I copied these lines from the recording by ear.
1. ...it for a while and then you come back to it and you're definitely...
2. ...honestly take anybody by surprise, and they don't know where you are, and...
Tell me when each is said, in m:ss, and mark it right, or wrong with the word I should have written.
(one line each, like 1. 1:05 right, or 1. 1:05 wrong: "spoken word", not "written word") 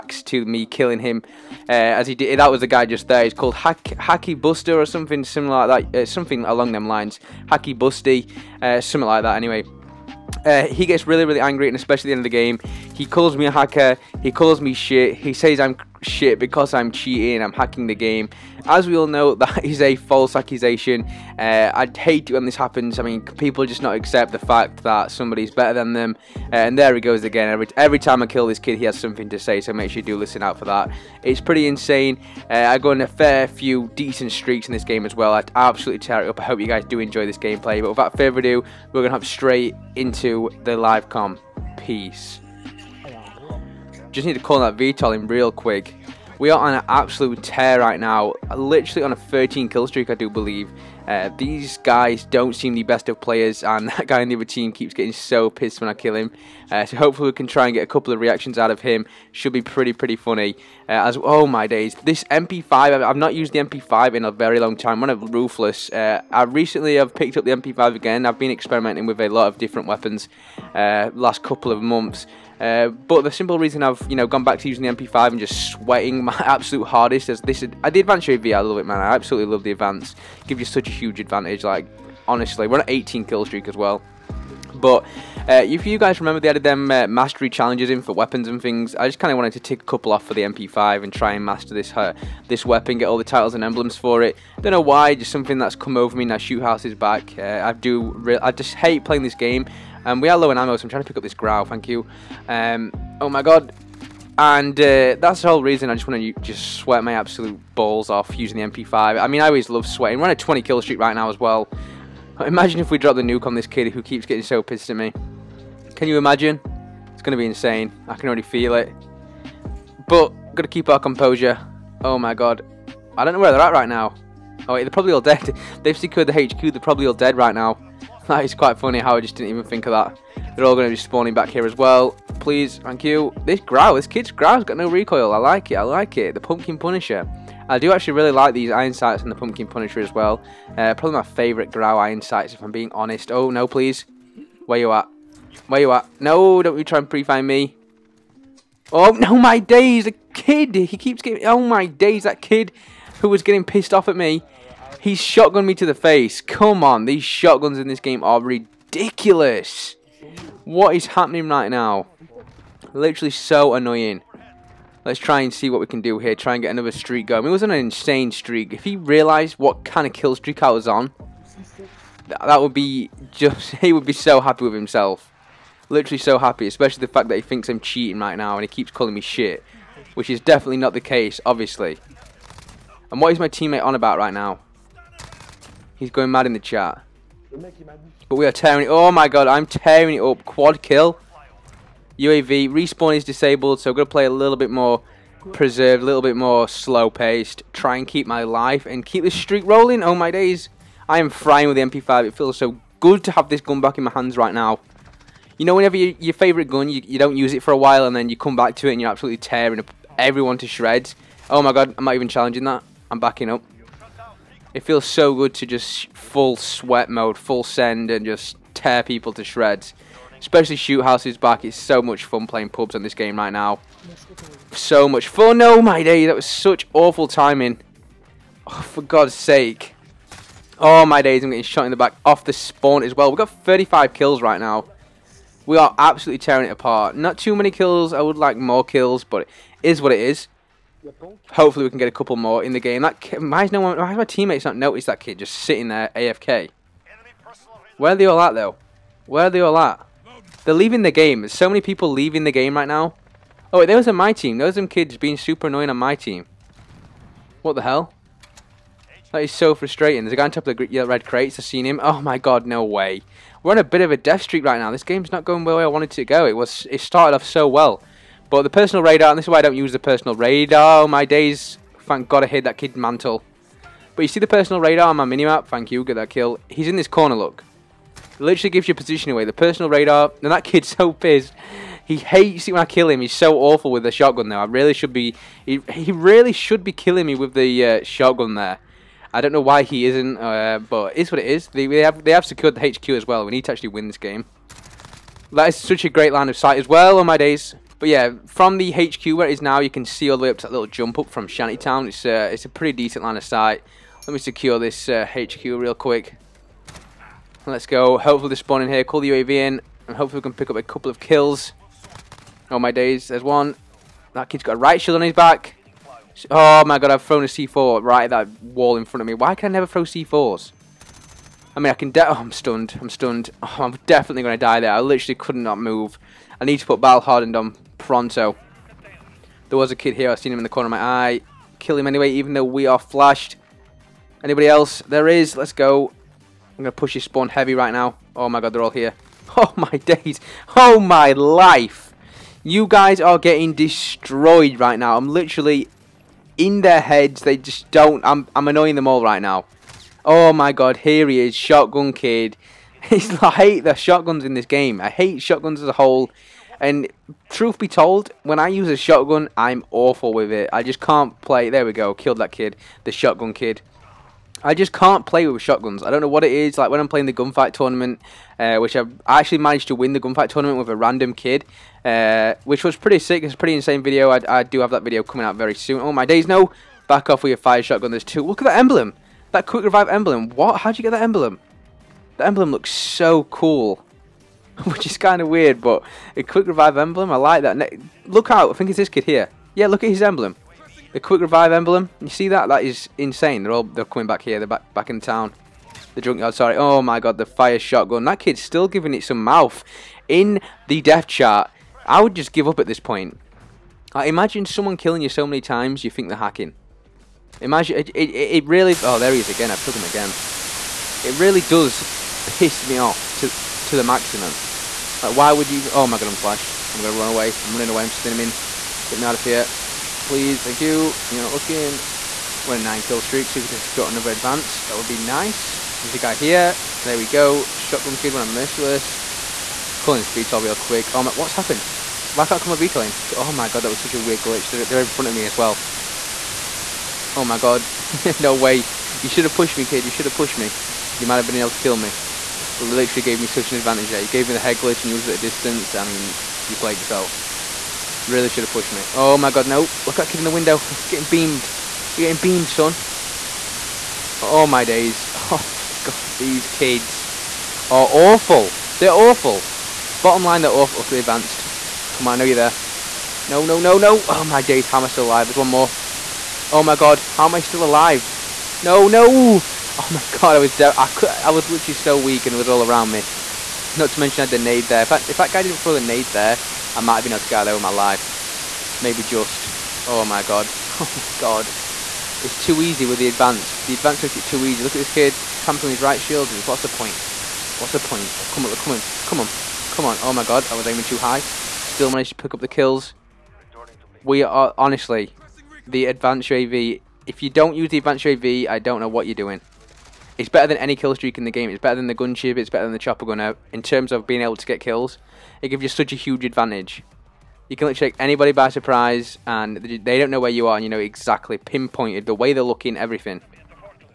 1. 3:27 wrong: "absolutely", not "definitely"
2. 8:27 wrong: "literally", not "honestly".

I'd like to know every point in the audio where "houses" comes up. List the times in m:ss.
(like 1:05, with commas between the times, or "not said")
1:36, 3:41.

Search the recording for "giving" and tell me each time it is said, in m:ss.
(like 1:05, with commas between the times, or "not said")
6:38.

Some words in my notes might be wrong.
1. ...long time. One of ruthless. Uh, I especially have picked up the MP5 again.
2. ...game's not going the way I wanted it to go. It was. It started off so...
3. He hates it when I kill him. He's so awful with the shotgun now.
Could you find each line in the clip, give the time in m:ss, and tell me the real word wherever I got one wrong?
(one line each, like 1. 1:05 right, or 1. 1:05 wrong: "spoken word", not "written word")
1. 1:04 wrong: "recently", not "especially"
2. 4:25 right
3. 4:42 right.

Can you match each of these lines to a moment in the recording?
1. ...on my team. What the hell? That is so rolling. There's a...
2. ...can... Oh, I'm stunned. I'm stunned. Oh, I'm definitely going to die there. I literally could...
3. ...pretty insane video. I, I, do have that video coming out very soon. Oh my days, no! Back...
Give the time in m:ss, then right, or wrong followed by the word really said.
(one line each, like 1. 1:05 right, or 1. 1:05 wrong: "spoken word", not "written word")
1. 4:15 wrong: "frustrating", not "rolling"
2. 5:21 right
3. 6:13 right.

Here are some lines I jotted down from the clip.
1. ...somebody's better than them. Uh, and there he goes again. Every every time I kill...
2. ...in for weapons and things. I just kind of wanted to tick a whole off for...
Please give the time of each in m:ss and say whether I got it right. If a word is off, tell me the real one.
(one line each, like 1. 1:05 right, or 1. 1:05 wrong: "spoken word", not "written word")
1. 0:25 right
2. 1:27 wrong: "couple", not "whole".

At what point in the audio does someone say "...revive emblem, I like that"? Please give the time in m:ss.
6:26.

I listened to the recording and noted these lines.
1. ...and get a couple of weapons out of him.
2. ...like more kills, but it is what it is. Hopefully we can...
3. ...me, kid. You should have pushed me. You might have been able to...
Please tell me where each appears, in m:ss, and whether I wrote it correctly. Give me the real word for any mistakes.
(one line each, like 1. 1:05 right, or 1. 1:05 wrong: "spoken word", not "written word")
1. 0:57 wrong: "reactions", not "weapons"
2. 3:58 right
3. 7:19 right.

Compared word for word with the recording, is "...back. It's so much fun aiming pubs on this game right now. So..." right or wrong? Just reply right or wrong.
wrong.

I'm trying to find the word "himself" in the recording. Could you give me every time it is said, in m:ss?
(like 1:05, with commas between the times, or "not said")
2:54.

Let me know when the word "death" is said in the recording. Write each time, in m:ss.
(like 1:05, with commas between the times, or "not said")
4:24, 6:41.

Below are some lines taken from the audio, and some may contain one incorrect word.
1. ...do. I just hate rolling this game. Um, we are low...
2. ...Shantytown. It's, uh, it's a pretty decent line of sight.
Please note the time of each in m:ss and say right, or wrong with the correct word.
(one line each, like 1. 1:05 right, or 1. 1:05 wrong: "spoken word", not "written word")
1. 1:37 wrong: "playing", not "rolling"
2. 5:01 right.